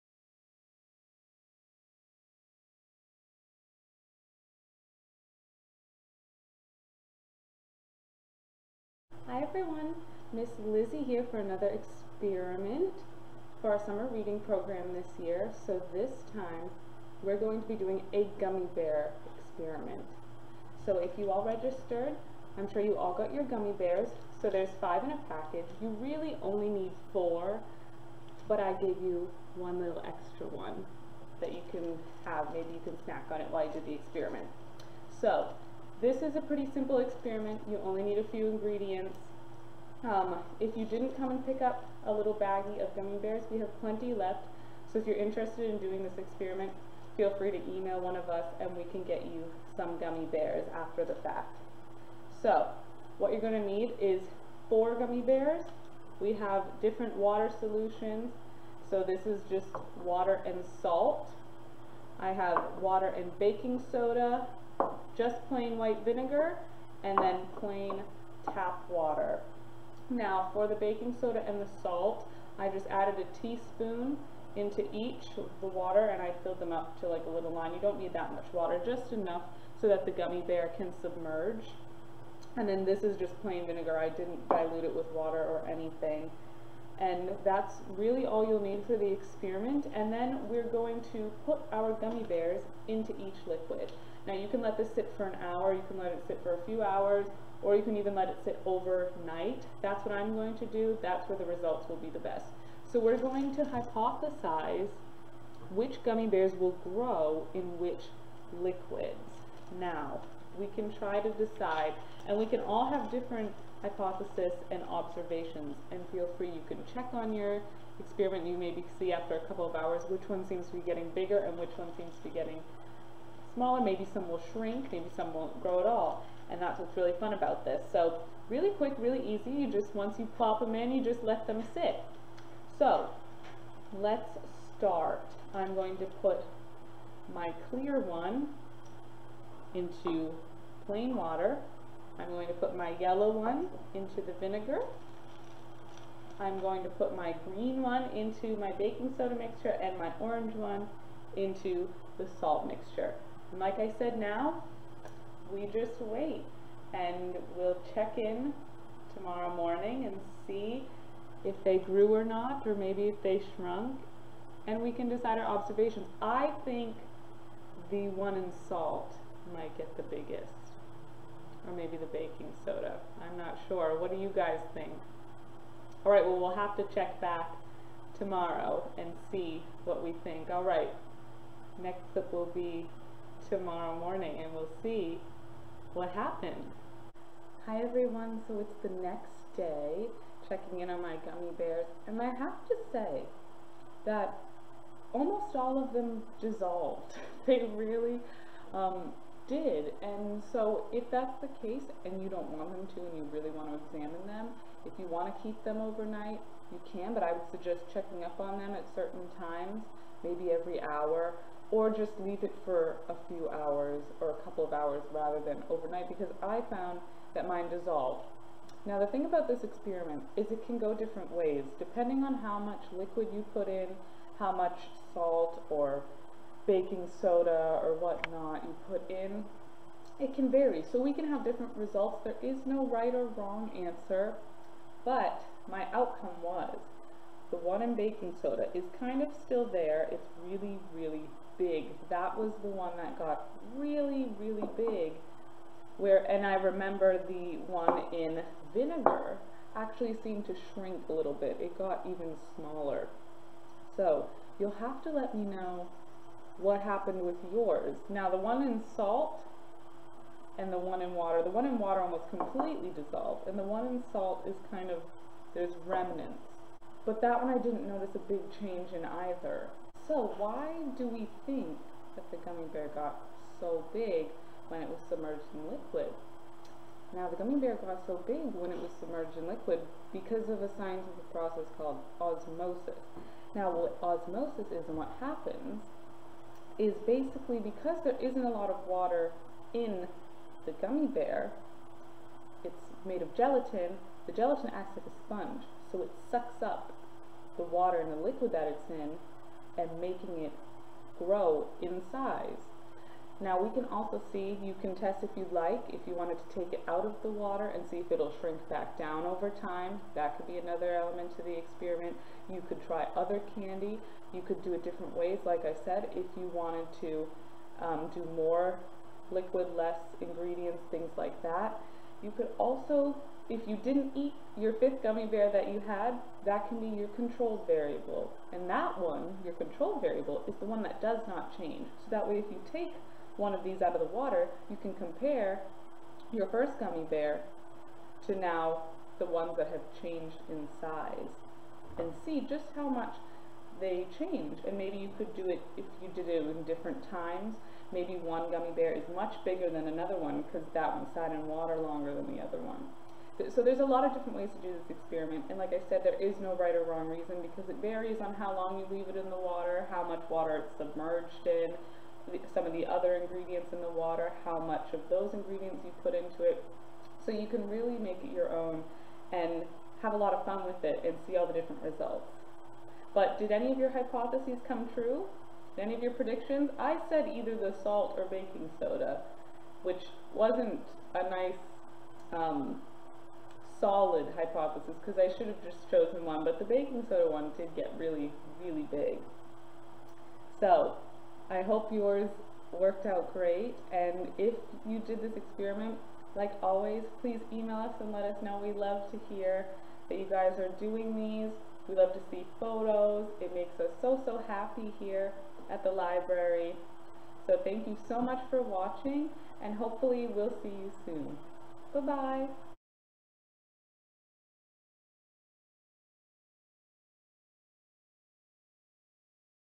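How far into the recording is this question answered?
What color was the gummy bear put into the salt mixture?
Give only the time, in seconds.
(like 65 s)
150 s.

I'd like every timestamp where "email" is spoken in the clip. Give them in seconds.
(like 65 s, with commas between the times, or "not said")
47 s, 397 s.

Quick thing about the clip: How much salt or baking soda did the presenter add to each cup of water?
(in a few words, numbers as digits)
a teaspoon.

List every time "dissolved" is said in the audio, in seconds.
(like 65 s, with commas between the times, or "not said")
196 s, 217 s, 262 s.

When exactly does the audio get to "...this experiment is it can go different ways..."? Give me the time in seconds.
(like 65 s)
219 s.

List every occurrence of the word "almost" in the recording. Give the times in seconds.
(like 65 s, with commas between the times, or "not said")
195 s, 262 s.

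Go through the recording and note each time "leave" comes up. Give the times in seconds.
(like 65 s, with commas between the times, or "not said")
212 s, 358 s.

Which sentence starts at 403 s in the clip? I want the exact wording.
It makes us so, so happy here at the library.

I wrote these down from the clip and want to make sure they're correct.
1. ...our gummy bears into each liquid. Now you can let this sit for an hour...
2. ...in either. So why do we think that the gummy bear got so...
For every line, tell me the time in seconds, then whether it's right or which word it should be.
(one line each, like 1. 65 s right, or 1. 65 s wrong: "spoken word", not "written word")
1. 91 s right
2. 268 s right.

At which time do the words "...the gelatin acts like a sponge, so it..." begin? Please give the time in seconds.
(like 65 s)
294 s.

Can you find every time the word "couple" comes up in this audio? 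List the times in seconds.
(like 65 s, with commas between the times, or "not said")
119 s, 214 s.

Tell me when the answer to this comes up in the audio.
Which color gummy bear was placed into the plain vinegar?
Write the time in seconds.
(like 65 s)
142 s.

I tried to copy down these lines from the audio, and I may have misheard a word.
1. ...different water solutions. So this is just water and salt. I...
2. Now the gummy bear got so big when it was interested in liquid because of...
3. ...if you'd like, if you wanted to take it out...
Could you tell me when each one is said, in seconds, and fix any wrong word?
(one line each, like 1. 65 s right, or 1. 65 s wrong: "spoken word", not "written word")
1. 56 s right
2. 277 s wrong: "submerged", not "interested"
3. 305 s right.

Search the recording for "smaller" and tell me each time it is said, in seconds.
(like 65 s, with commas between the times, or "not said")
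123 s, 252 s.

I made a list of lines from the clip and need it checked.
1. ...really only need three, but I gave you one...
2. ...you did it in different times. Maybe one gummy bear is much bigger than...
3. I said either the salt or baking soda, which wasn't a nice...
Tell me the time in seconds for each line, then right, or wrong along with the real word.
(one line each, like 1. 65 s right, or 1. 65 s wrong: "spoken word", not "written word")
1. 26 s wrong: "four", not "three"
2. 346 s right
3. 376 s right.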